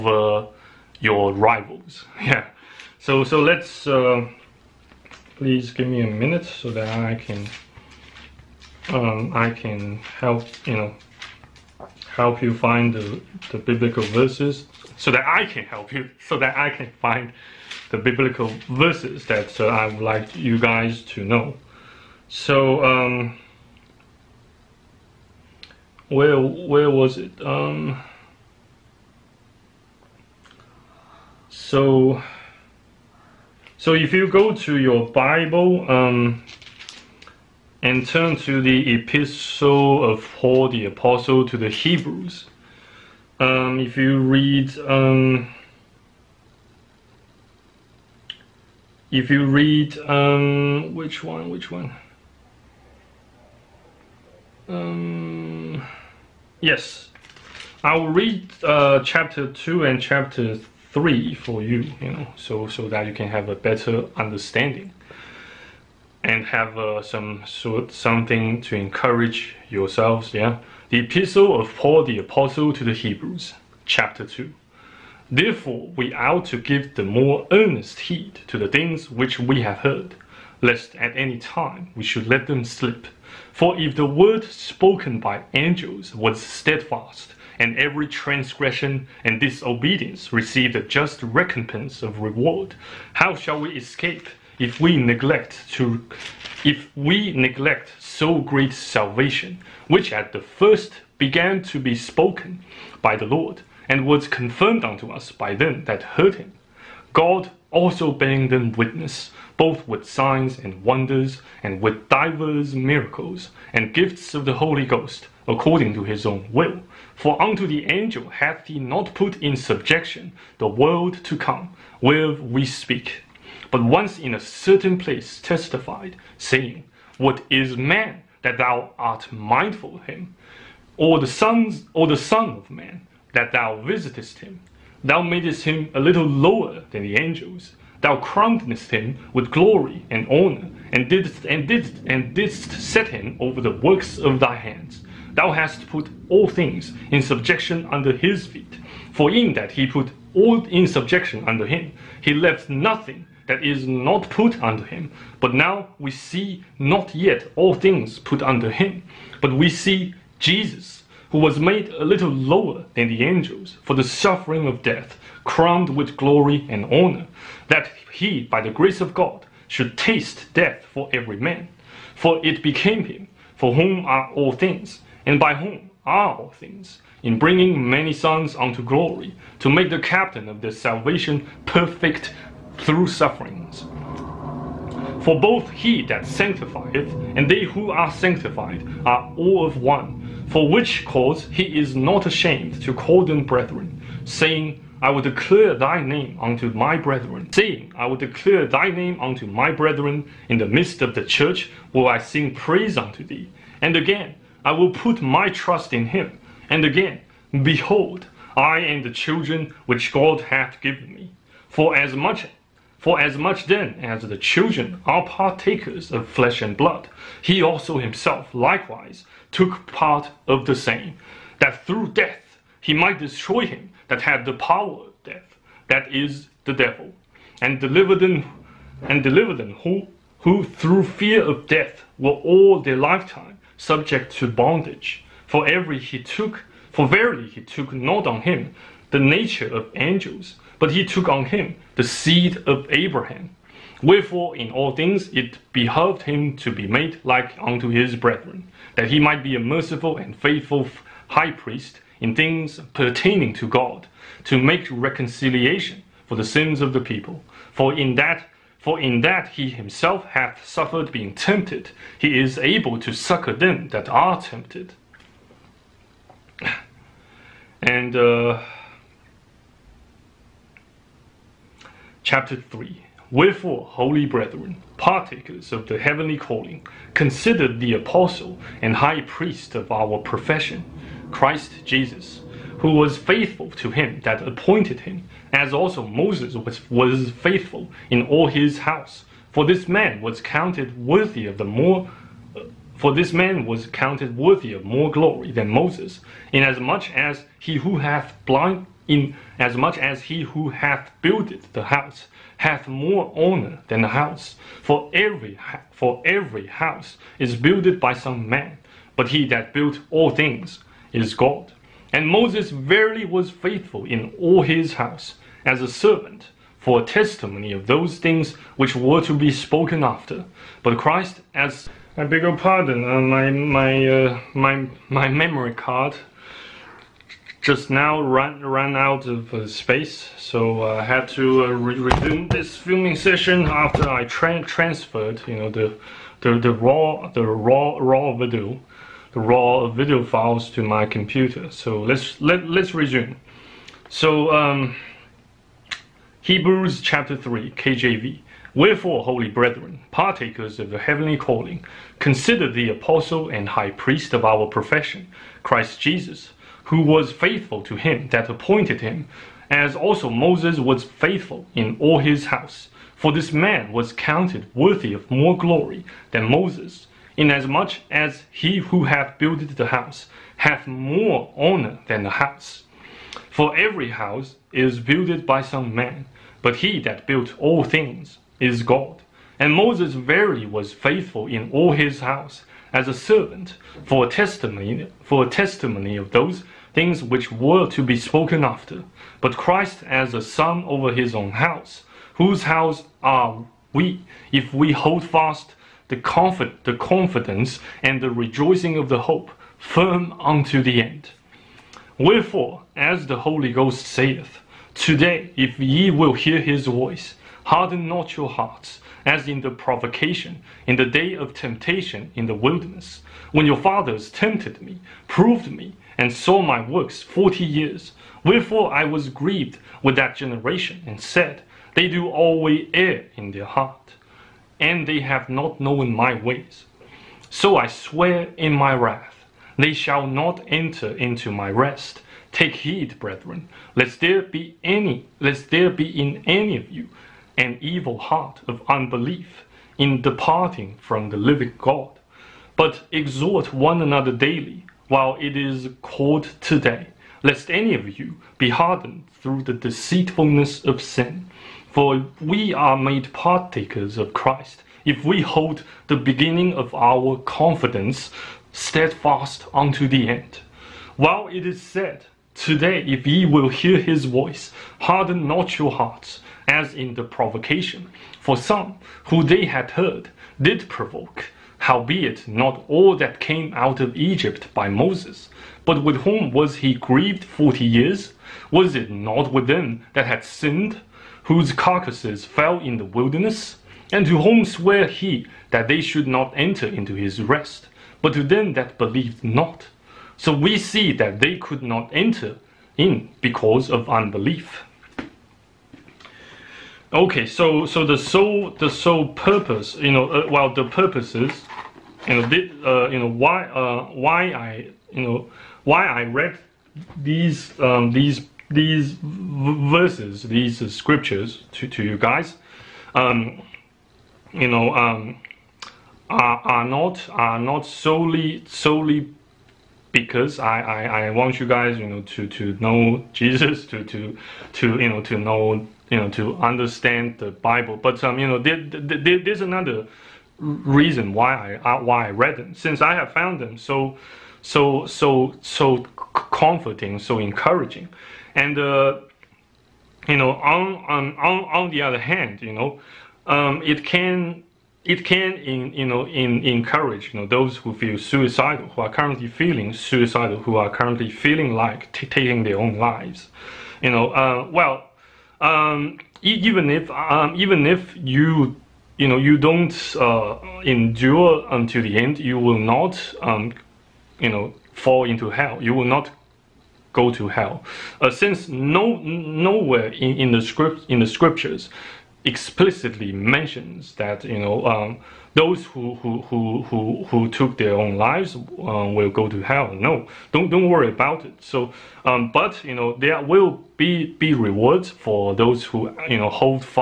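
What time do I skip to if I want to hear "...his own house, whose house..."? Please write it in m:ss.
6:31.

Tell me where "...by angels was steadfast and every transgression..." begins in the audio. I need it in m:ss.
1:25.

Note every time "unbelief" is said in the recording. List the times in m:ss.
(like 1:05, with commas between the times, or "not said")
7:18, 8:14.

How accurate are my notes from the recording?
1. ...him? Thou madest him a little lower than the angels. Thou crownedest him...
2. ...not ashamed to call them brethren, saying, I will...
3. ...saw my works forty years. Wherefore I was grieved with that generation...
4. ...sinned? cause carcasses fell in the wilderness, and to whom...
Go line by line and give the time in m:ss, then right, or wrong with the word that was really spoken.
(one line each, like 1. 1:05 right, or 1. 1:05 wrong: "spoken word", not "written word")
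1. 2:14 right
2. 3:11 right
3. 6:56 right
4. 8:00 wrong: "whose", not "cause".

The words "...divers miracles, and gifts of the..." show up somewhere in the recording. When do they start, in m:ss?
1:52.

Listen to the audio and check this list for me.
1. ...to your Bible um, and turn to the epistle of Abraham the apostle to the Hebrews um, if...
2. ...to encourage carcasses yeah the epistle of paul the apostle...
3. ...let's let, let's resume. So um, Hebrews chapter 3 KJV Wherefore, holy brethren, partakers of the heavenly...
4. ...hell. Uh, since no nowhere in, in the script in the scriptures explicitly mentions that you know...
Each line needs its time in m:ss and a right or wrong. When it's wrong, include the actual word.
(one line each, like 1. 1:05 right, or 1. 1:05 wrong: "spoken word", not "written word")
1. 0:34 wrong: "Paul", not "Abraham"
2. 1:08 wrong: "yourselves", not "carcasses"
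3. 5:42 right
4. 9:27 right.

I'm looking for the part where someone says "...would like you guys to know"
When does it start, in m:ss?
0:19.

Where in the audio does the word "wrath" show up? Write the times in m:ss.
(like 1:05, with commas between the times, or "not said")
7:08.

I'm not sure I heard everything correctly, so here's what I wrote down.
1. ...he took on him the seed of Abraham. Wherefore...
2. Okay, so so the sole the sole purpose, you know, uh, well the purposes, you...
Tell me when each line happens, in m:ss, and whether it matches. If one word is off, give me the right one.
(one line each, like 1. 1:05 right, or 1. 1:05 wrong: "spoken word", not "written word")
1. 4:00 right
2. 8:17 right.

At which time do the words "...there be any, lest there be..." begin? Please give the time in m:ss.
7:14.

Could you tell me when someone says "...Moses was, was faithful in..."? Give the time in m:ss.
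4:46.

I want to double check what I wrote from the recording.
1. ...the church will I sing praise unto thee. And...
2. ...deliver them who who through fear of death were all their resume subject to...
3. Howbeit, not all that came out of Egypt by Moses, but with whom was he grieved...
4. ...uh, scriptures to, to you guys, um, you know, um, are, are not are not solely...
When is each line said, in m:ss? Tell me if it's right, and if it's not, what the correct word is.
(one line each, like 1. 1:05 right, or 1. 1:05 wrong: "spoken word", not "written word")
1. 3:21 right
2. 3:49 wrong: "lifetime", not "resume"
3. 7:51 right
4. 8:30 right.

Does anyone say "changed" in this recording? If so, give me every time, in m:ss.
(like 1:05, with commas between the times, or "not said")
not said.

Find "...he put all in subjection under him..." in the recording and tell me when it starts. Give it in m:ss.
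2:29.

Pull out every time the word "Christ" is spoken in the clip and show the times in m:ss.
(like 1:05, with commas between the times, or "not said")
4:41, 5:20, 5:55, 6:29, 7:34.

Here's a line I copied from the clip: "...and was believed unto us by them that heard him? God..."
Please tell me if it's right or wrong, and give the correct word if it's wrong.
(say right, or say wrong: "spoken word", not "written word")
wrong: "confirmed", not "believed".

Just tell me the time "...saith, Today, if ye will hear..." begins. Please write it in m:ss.
6:44.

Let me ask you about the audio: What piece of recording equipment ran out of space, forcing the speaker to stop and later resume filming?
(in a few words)
memory card.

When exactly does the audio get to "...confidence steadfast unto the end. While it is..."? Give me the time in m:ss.
7:37.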